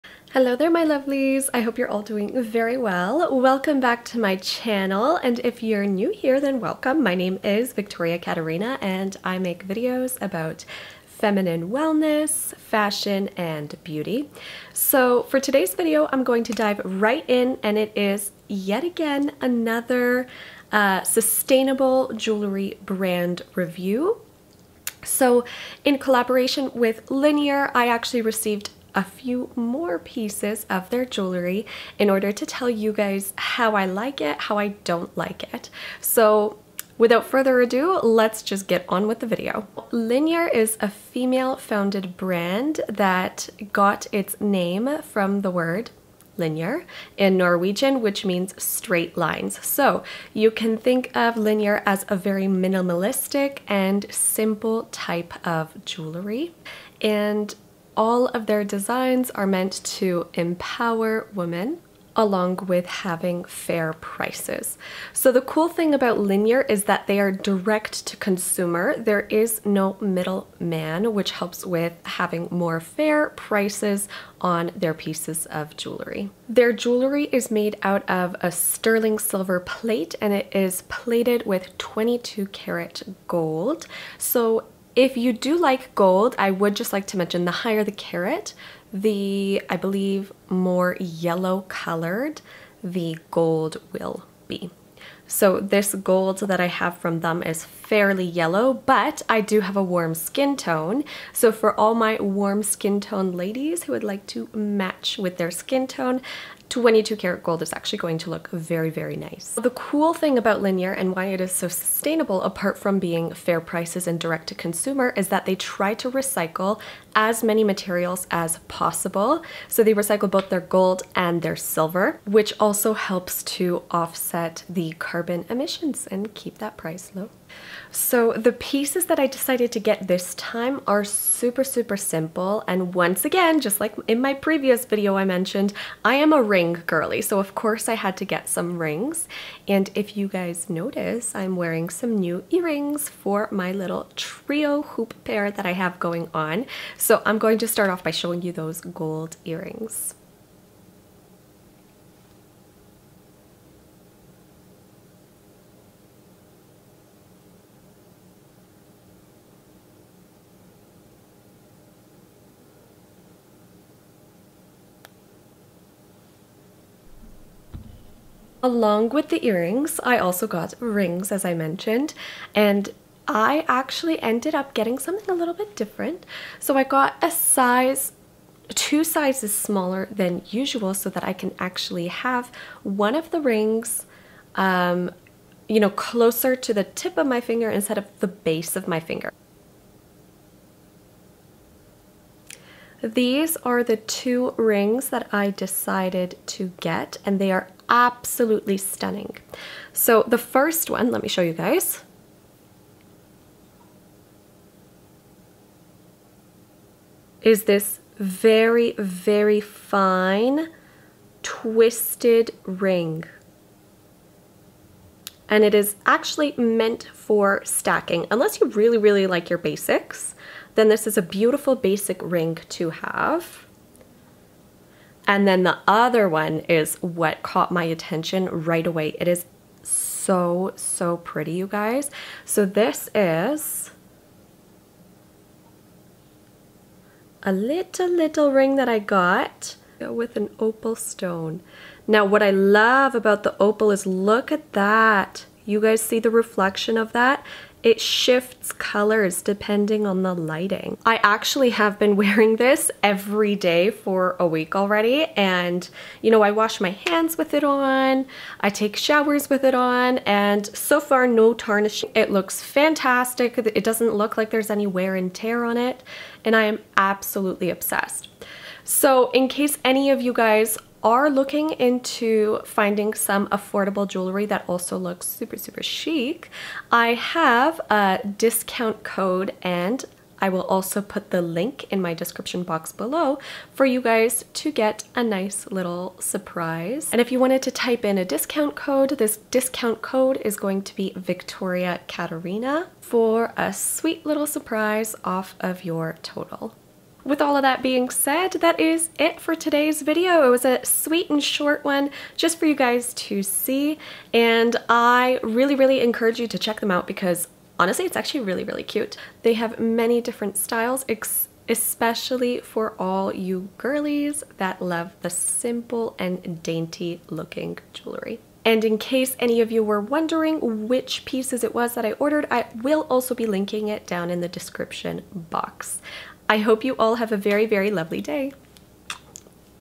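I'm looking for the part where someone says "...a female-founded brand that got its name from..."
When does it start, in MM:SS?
00:40.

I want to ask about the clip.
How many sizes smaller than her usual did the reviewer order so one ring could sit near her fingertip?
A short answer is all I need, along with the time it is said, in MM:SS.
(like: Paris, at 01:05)
2, at 02:58.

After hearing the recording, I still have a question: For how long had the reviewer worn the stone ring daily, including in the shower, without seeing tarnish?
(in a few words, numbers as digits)
a week.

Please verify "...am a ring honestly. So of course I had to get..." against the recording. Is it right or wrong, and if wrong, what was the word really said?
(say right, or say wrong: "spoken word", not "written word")
wrong: "girly", not "honestly".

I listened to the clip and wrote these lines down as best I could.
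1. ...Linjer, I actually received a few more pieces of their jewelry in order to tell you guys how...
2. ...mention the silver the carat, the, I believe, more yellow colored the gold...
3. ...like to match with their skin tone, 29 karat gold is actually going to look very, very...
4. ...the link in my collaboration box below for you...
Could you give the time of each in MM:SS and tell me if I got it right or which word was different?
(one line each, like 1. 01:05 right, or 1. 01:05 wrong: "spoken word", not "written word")
1. 00:27 right
2. 01:27 wrong: "higher", not "silver"
3. 01:44 wrong: "22", not "29"
4. 04:41 wrong: "description", not "collaboration".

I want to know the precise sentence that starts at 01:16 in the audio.
Their jewelry is made out of a sterling silver plate and it is plated with 22 karat gold.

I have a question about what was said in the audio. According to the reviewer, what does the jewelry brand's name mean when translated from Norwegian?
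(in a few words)
straight lines.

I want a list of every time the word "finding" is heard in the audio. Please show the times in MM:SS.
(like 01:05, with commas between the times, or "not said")
04:32.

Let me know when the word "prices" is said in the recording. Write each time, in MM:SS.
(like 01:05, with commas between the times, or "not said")
01:03, 01:13, 01:53, 02:06.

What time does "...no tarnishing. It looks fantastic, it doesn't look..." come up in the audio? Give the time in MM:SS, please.
04:21.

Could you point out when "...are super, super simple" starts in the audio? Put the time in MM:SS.
02:10.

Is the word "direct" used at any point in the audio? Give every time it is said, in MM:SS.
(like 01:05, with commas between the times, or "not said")
01:07, 01:54.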